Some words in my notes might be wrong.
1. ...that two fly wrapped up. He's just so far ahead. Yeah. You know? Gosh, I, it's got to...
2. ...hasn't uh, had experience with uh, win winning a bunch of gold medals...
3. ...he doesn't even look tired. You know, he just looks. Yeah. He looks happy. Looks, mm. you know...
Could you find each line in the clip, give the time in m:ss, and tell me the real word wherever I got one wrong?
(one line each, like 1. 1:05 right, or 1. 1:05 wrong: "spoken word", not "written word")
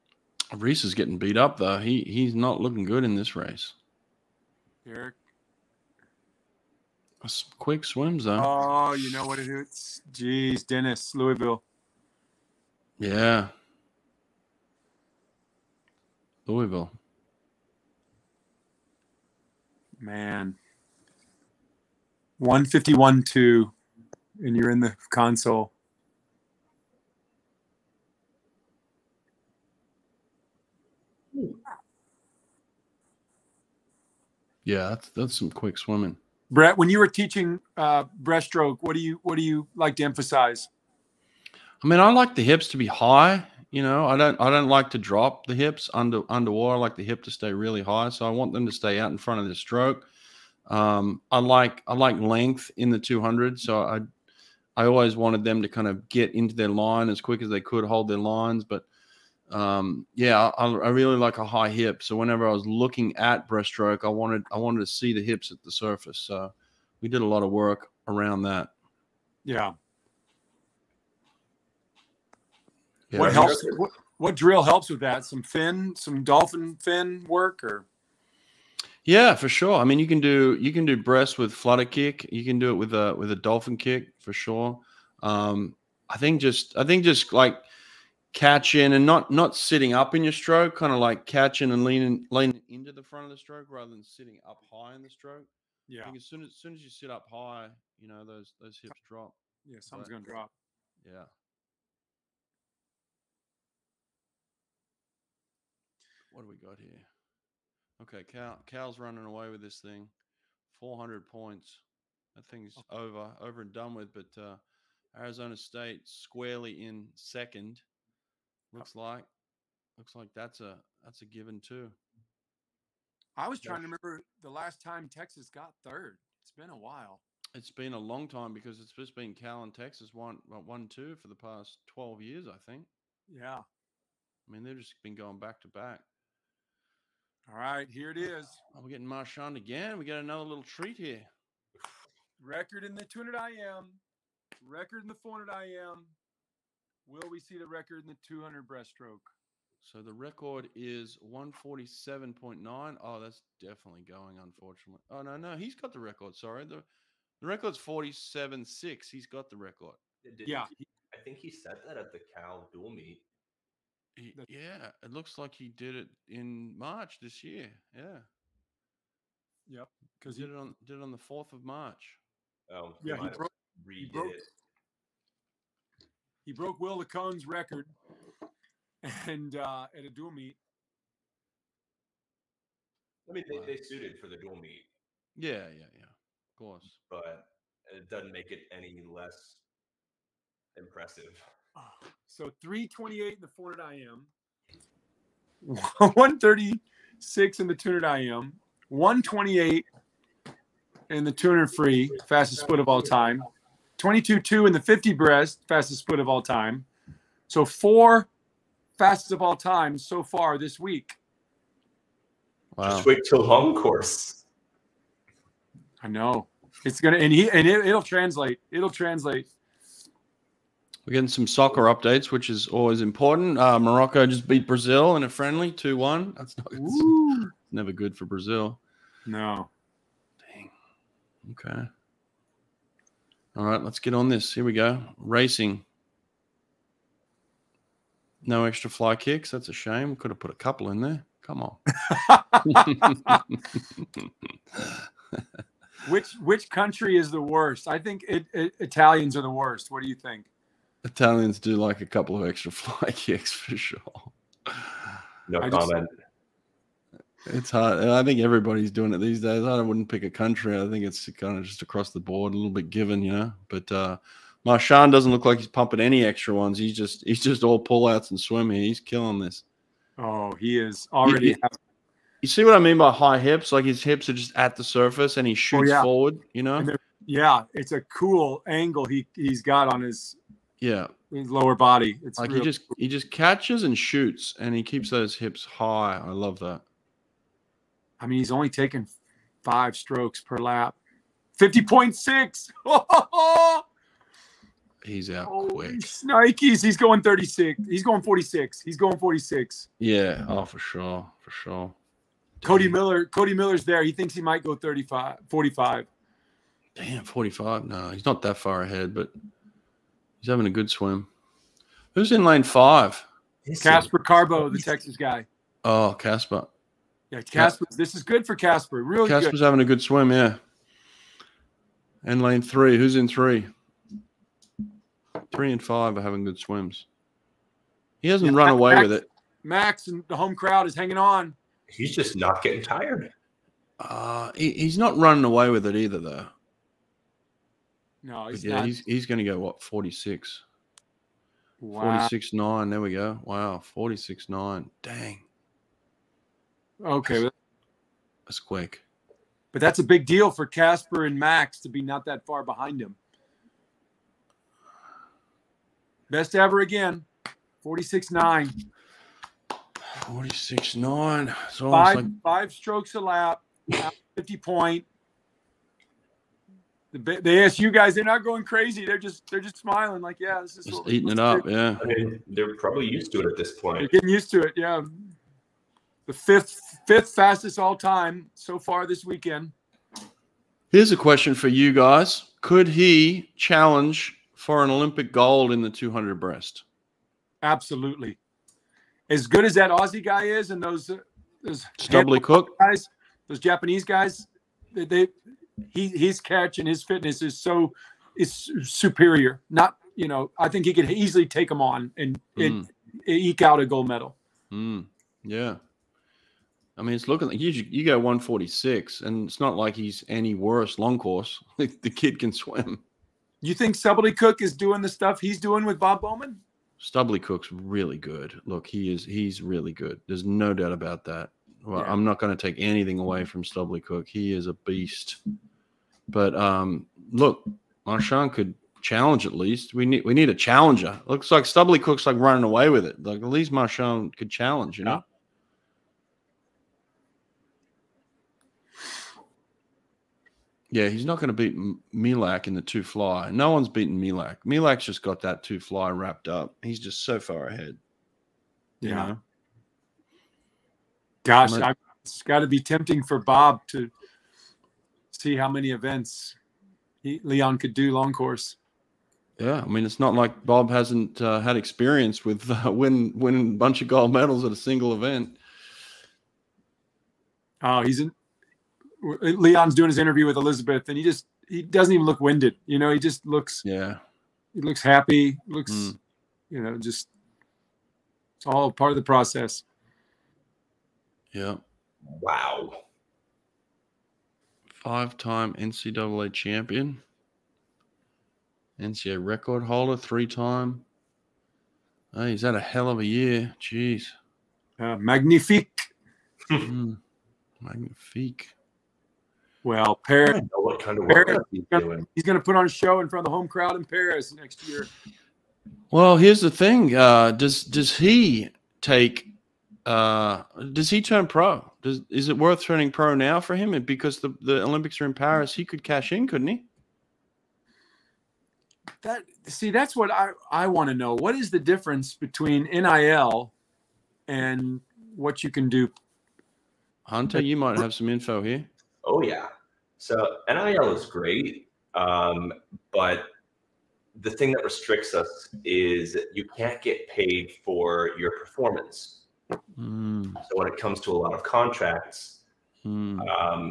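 1. 7:25 right
2. 7:40 right
3. 7:51 wrong: "winded", not "tired".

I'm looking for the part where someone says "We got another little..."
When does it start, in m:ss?
2:19.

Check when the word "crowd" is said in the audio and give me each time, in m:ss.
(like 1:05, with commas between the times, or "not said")
5:30, 8:23.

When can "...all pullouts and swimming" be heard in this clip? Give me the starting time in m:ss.
4:27.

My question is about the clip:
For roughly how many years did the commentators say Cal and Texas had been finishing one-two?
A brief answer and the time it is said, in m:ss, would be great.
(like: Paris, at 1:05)
12, at 2:11.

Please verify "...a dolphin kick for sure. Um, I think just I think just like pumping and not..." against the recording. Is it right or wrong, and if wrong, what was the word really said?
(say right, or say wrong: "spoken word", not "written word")
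wrong: "catching", not "pumping".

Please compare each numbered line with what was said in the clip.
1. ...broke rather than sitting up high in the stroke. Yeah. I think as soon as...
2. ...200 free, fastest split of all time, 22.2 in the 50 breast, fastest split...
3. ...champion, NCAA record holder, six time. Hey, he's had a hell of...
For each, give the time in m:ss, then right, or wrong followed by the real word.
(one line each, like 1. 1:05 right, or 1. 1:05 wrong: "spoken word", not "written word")
1. 1:33 wrong: "stroke", not "broke"
2. 3:21 right
3. 8:06 wrong: "three", not "six".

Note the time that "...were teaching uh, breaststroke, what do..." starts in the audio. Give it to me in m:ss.
0:36.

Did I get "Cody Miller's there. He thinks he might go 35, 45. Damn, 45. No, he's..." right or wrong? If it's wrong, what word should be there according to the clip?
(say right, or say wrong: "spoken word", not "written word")
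right.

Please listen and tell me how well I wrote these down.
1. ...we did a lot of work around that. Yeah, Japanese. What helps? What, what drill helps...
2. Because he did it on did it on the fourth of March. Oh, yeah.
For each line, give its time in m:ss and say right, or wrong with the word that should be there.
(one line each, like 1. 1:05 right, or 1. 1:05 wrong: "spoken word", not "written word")
1. 1:07 wrong: "Yeah", not "Japanese"
2. 2:50 right.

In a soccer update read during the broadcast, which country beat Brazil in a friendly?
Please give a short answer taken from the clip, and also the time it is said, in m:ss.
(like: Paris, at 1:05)
Morocco, at 3:43.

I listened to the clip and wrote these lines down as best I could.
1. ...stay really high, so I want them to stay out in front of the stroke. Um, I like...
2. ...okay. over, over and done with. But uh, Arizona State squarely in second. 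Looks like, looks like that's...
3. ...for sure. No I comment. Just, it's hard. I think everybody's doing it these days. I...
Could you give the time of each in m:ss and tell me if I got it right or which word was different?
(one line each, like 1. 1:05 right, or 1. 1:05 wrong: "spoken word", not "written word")
1. 0:47 right
2. 1:52 right
3. 4:13 right.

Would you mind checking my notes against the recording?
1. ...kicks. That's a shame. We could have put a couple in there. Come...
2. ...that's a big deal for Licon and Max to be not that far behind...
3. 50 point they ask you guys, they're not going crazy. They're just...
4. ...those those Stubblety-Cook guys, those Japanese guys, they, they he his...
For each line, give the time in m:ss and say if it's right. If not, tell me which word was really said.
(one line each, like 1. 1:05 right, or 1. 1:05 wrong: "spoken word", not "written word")
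1. 3:59 right
2. 5:49 wrong: "Caspar", not "Licon"
3. 6:04 right
4. 6:30 right.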